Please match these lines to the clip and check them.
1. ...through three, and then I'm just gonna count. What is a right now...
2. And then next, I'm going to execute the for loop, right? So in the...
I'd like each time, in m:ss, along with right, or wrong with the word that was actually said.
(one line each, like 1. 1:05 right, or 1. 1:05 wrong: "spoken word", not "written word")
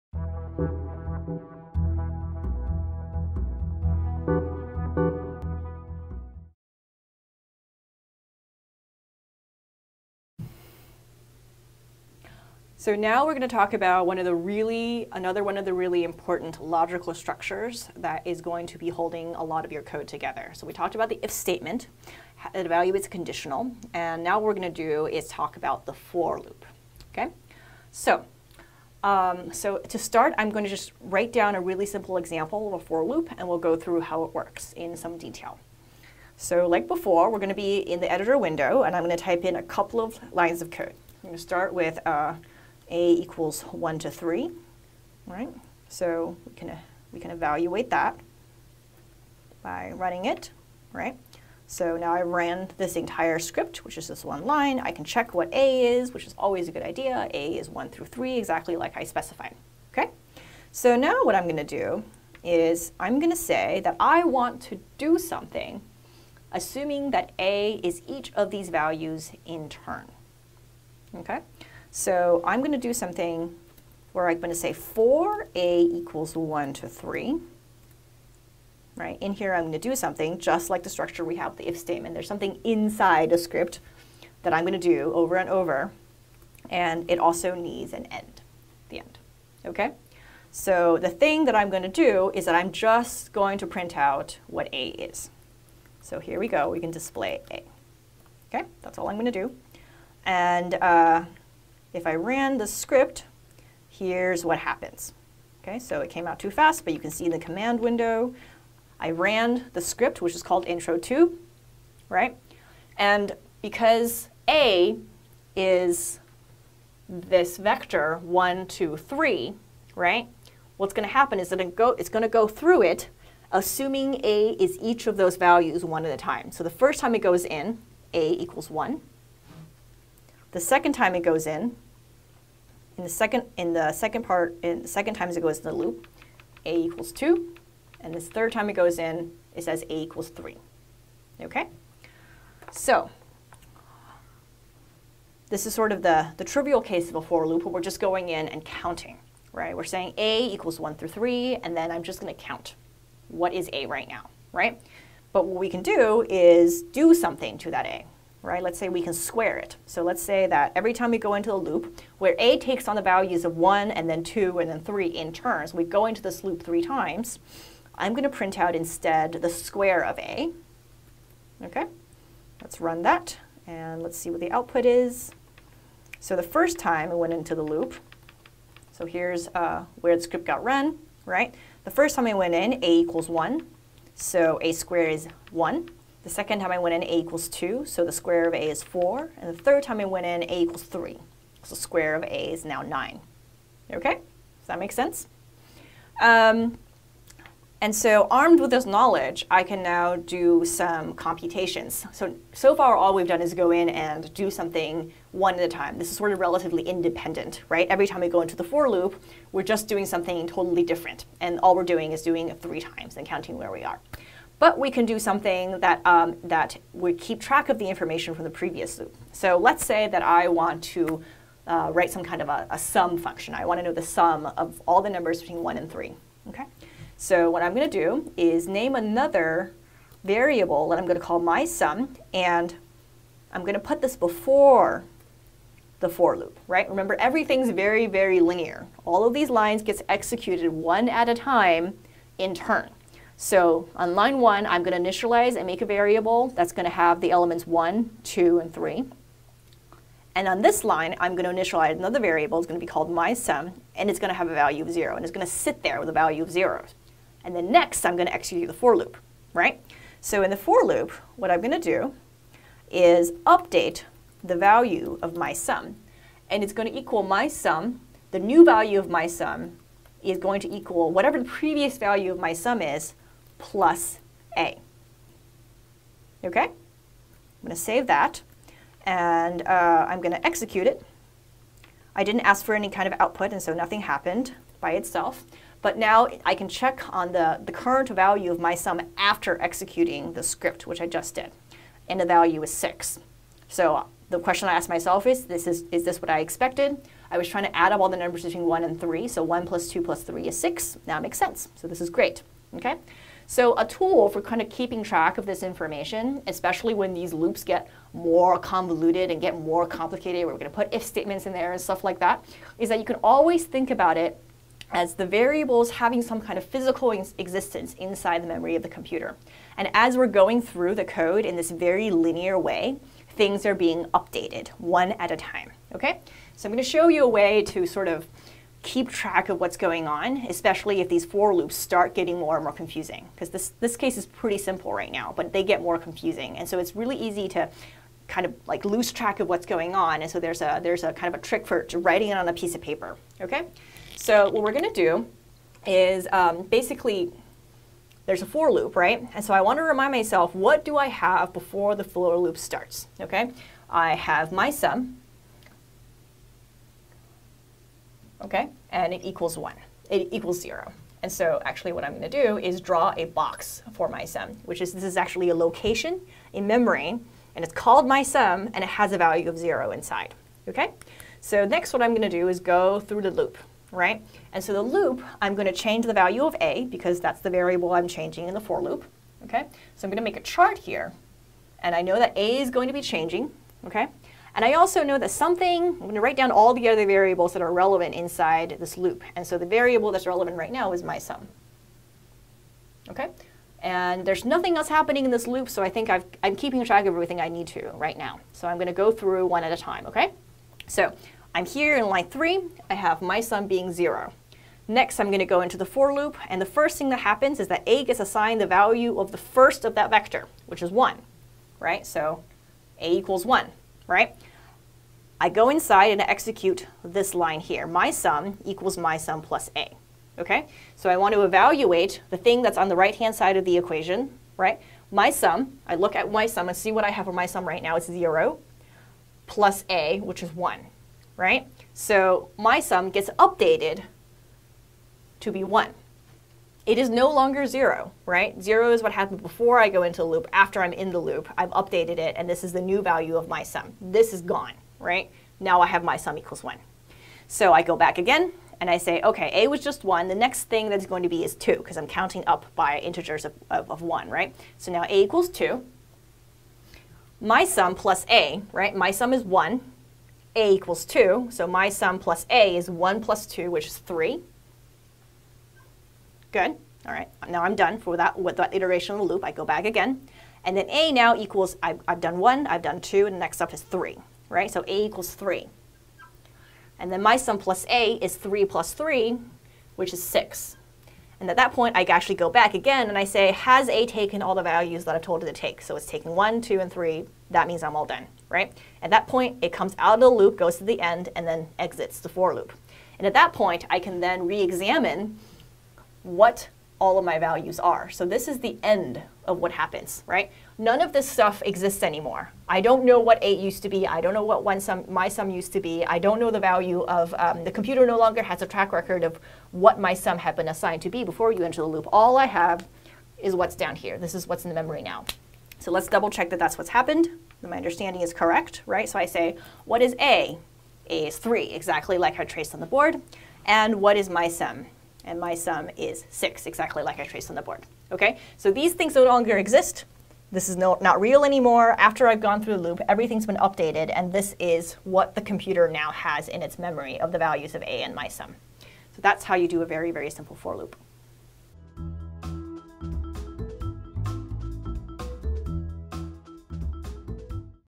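1. 2:30 right
2. 4:17 right.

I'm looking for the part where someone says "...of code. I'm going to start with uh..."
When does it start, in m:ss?
0:40.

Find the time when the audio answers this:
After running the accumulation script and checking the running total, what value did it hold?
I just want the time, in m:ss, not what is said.
4:52.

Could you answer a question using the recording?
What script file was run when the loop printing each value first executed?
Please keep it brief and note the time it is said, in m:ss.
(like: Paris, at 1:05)
intro2, at 1:50.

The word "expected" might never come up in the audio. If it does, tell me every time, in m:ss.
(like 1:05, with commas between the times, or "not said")
4:56.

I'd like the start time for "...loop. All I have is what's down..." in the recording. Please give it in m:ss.
8:31.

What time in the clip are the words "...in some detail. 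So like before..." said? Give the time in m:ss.
0:34.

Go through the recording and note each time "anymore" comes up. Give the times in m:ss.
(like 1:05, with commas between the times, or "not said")
8:22, 8:51.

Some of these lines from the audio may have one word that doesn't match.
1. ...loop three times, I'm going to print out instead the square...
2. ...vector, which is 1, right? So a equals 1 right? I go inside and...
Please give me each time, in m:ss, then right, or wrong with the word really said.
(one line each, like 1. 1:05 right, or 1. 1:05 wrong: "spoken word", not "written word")
1. 2:46 right
2. 6:50 right.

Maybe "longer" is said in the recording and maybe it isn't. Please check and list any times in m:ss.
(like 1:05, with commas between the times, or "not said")
7:17, 8:28, 8:49.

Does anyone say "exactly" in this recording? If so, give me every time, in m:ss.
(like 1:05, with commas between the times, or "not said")
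0:58, 8:41, 8:46.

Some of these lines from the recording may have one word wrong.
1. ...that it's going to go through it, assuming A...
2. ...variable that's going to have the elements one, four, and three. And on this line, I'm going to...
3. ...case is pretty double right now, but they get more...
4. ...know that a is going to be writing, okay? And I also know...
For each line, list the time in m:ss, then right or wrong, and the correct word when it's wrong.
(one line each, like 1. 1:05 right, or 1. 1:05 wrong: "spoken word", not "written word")
1. 2:01 right
2. 4:05 wrong: "two", not "four"
3. 5:33 wrong: "simple", not "double"
4. 6:22 wrong: "changing", not "writing".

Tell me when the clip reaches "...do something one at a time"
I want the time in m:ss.
3:24.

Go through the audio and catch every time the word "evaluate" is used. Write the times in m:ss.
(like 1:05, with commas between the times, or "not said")
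0:22, 0:47, 7:01.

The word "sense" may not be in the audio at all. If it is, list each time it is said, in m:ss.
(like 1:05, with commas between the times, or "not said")
3:14, 5:01.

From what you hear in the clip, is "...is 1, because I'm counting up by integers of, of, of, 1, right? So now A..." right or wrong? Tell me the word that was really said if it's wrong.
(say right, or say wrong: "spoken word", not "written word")
wrong: "2", not "1".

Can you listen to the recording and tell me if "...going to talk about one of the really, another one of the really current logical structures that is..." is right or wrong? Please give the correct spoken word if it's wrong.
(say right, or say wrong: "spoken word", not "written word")
wrong: "important", not "current".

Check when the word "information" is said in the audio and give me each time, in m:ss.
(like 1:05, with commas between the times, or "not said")
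3:37, 5:05.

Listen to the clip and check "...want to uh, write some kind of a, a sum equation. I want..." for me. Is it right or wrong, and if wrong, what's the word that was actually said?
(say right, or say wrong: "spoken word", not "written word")
wrong: "function", not "equation".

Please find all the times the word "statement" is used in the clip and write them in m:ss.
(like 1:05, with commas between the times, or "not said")
0:21, 1:21, 5:11.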